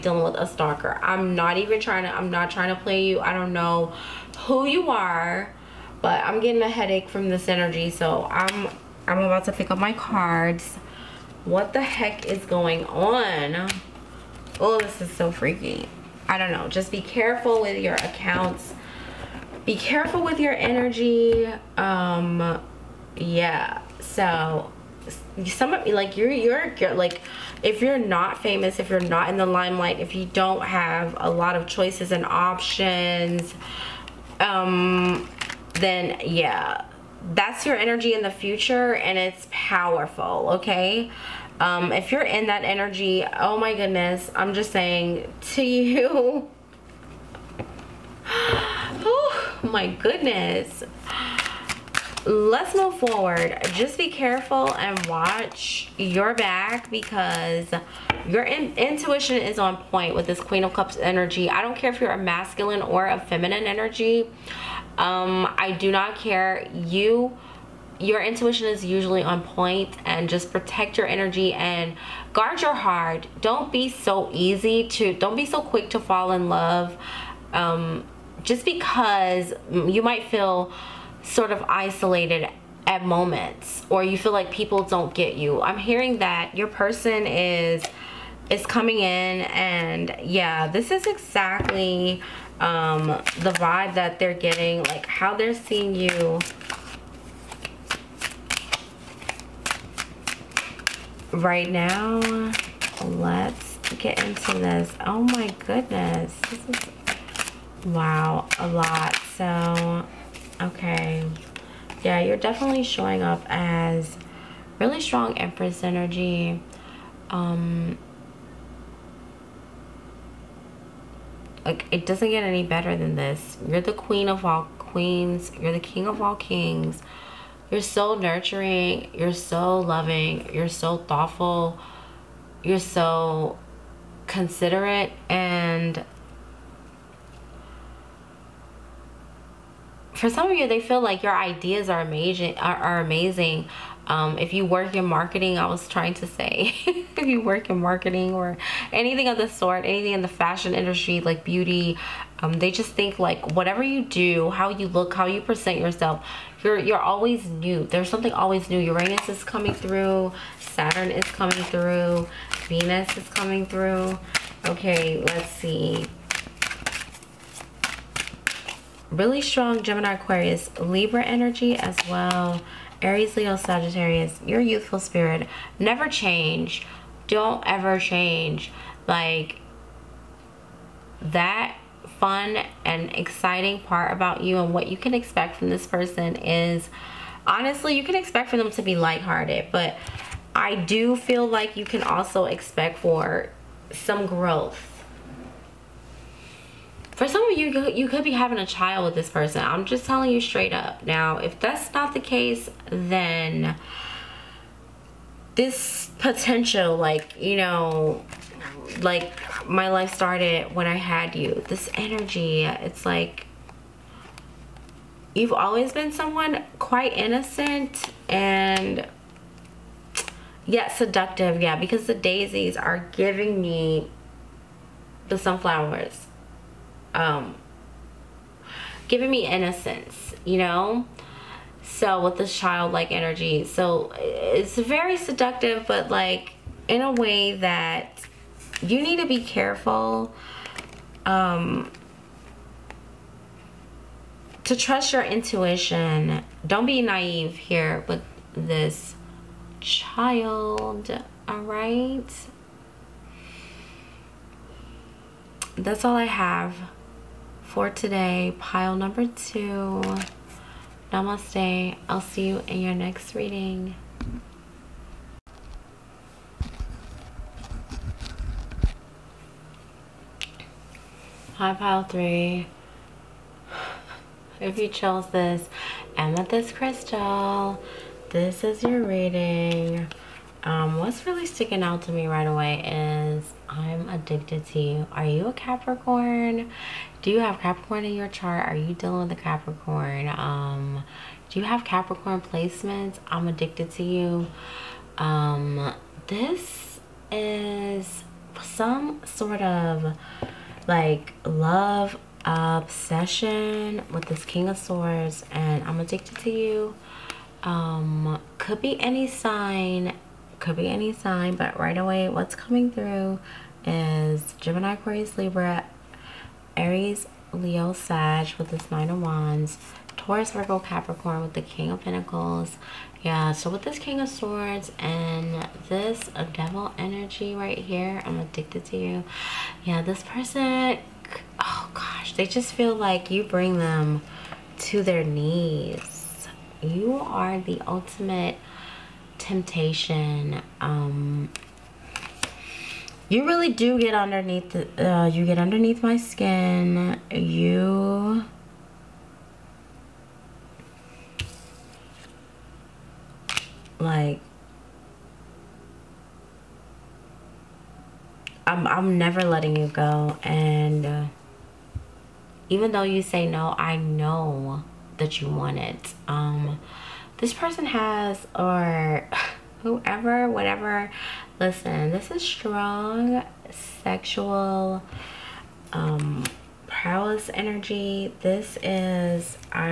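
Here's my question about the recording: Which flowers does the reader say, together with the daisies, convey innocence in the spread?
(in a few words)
sunflowers.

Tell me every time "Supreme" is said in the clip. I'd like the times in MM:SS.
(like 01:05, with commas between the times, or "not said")
not said.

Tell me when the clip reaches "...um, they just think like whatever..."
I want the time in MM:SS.
02:32.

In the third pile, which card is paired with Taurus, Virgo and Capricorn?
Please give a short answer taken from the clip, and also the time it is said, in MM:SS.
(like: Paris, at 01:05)
King of Pentacles, at 05:21.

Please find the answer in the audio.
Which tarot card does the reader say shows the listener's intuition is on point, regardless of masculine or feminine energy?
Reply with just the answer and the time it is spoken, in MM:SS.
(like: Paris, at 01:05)
Queen of Cups, at 01:00.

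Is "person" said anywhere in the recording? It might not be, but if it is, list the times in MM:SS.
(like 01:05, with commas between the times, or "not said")
01:26, 03:05, 03:19, 05:30, 06:07.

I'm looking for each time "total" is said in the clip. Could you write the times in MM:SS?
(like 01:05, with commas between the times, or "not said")
not said.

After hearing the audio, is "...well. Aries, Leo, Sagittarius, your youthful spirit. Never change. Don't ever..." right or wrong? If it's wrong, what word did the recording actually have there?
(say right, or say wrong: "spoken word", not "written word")
right.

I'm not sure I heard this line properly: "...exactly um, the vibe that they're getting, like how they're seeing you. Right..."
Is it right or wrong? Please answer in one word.
right.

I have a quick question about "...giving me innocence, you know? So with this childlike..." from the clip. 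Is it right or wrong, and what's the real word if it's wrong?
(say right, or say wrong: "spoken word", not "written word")
right.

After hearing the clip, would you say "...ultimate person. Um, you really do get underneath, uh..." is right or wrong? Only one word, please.
wrong.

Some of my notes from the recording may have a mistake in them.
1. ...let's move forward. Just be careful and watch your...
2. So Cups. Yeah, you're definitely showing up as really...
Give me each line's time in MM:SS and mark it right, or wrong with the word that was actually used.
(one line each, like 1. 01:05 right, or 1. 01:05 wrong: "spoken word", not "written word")
1. 00:52 right
2. 01:49 wrong: "Okay", not "Cups".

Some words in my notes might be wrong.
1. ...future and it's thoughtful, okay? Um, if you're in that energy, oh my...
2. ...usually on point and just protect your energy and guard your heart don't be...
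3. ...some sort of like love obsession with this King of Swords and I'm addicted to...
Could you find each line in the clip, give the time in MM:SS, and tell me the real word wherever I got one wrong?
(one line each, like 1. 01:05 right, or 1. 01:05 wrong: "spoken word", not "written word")
1. 00:38 wrong: "powerful", not "thoughtful"
2. 01:08 right
3. 04:58 right.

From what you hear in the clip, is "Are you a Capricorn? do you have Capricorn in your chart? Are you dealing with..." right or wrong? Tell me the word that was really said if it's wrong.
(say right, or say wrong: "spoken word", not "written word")
right.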